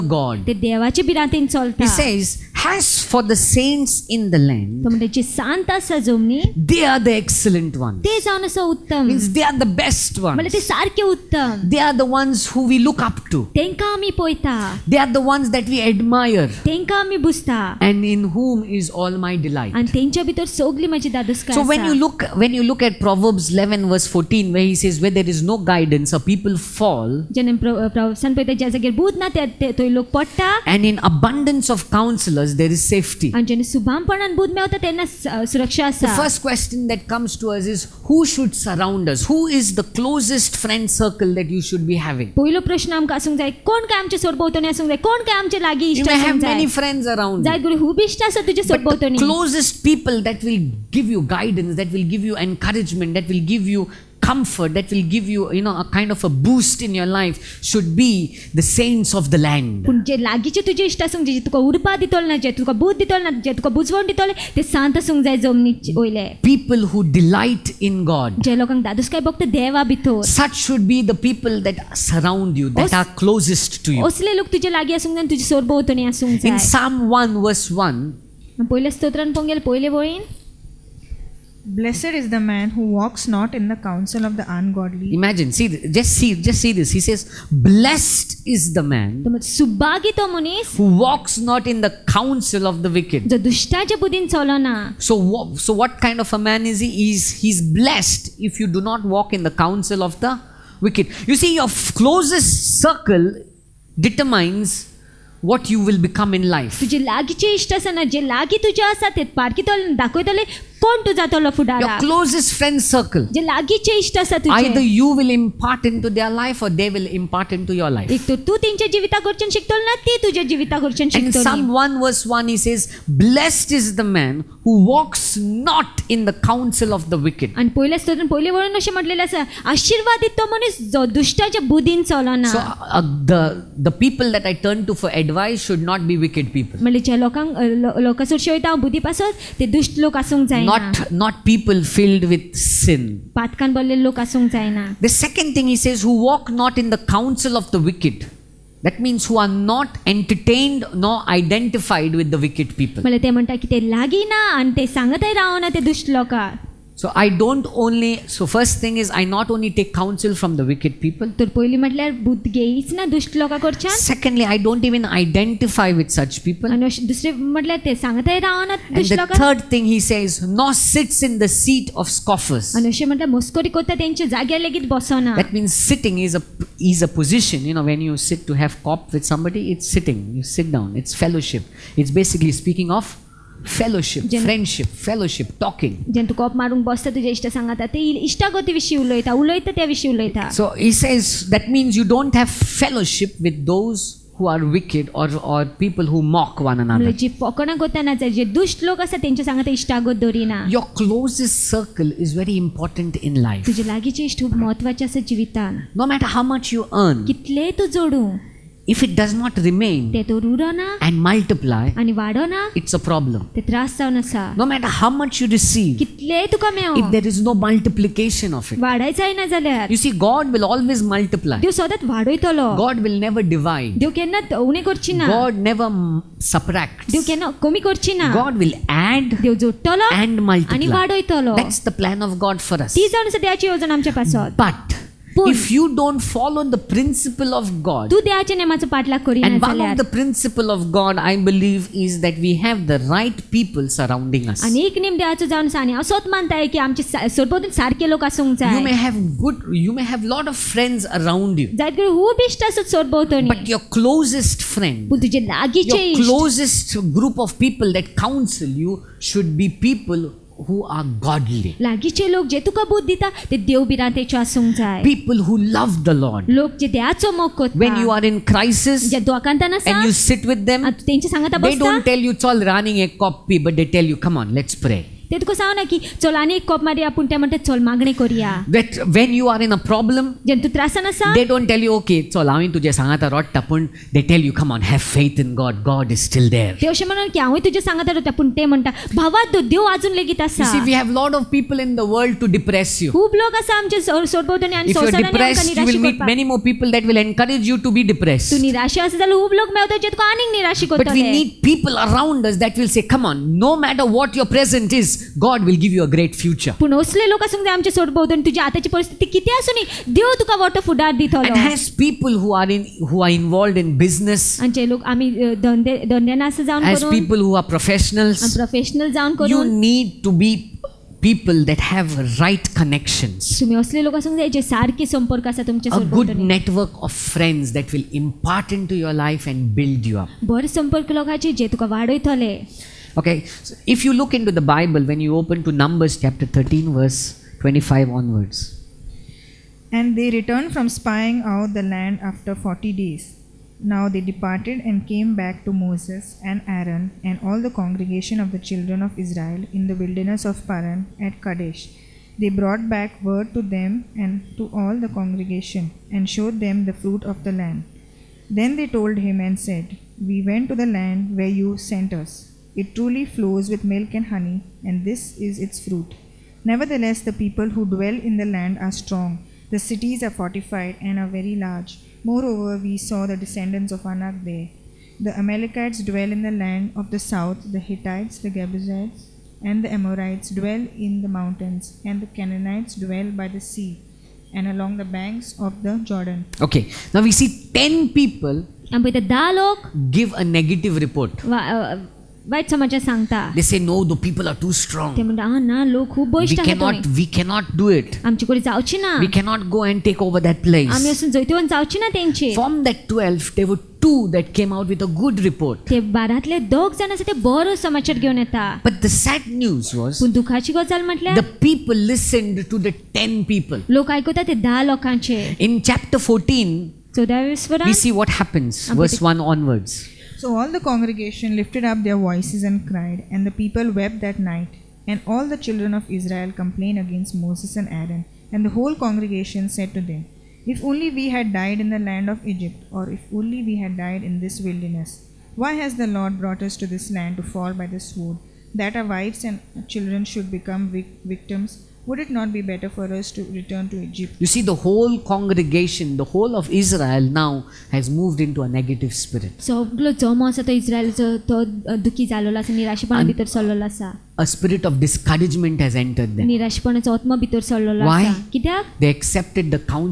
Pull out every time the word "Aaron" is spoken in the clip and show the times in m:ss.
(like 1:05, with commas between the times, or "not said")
5:46, 7:07.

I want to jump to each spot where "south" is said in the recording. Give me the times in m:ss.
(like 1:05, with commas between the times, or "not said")
6:17.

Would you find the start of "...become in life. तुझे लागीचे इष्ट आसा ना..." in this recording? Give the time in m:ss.
1:45.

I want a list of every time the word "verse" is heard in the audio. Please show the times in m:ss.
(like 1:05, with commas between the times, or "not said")
0:23, 1:17, 2:02, 5:36, 6:59.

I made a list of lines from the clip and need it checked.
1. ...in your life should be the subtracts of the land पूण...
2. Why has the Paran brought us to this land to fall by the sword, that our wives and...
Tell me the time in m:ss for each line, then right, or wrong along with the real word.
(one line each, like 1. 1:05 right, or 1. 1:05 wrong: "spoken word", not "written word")
1. 0:56 wrong: "saints", not "subtracts"
2. 7:15 wrong: "Lord", not "Paran".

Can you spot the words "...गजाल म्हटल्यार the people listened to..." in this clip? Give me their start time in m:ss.
6:50.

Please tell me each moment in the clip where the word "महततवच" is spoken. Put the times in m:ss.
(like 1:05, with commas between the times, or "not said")
3:24.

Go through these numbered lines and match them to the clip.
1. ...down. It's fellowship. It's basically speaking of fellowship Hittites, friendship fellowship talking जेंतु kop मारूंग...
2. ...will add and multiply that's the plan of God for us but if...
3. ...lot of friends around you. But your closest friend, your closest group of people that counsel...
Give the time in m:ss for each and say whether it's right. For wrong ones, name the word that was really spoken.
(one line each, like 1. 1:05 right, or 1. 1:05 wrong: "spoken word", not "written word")
1. 3:00 wrong: "Jen", not "Hittites"
2. 3:48 right
3. 4:10 right.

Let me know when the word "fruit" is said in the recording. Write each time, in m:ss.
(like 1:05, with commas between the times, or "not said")
5:56, 6:05.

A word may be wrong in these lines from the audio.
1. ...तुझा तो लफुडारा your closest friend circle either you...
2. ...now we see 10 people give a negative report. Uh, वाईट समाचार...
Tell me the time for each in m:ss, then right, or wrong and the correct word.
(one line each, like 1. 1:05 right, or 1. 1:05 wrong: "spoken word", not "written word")
1. 1:51 right
2. 6:27 right.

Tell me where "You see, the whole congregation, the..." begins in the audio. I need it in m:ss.
7:24.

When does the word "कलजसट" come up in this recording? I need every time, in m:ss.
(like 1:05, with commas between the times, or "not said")
0:49.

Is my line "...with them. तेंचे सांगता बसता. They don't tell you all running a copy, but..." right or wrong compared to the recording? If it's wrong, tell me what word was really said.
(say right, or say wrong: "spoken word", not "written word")
right.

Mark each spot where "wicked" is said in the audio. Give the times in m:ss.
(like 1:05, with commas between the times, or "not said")
1:32, 1:40, 2:07, 2:16, 2:27, 2:32, 2:40, 3:14.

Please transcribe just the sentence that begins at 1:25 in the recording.
Imagine, see, just see, just see this.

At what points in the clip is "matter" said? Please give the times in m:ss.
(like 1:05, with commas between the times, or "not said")
3:26, 3:34.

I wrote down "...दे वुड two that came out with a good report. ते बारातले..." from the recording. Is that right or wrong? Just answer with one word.
right.